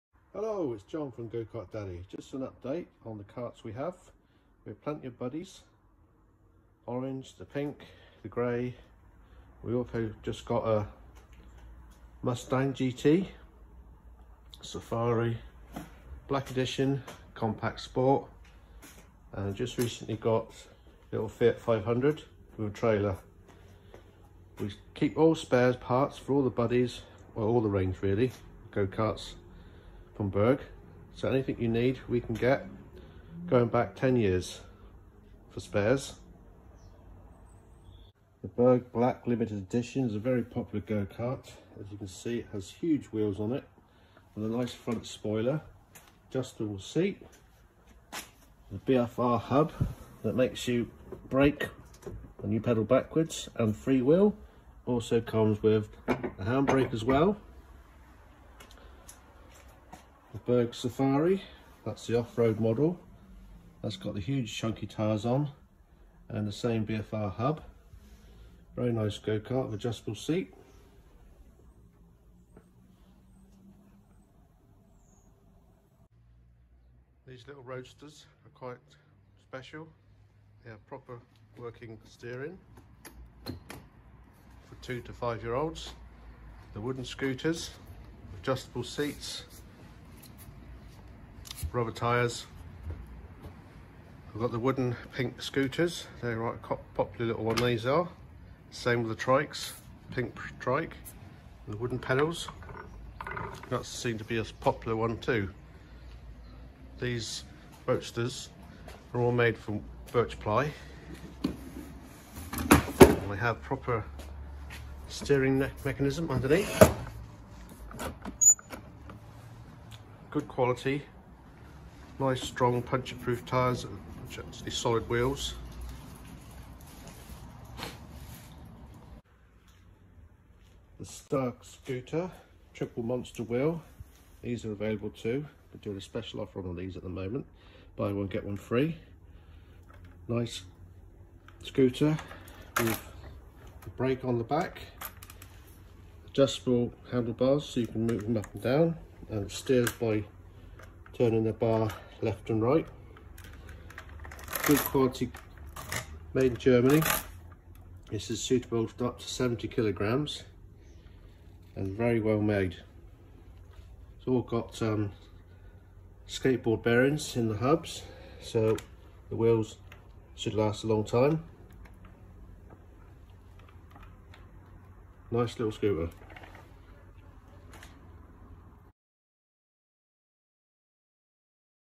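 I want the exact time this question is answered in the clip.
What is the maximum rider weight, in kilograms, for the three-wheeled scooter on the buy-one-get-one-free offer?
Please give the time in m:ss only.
2:39.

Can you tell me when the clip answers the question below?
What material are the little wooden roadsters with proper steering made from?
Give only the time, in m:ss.
1:50.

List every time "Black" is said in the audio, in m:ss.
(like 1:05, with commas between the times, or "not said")
0:16, 0:38.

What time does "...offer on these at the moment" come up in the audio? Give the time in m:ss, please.
2:16.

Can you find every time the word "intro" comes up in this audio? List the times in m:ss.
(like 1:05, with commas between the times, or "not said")
not said.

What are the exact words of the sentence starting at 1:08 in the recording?
Very nice go-kart with adjustable seat.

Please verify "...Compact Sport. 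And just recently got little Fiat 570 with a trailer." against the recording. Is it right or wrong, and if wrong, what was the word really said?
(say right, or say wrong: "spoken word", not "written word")
wrong: "500", not "570".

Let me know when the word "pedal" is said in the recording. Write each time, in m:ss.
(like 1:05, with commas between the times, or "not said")
0:52, 1:41.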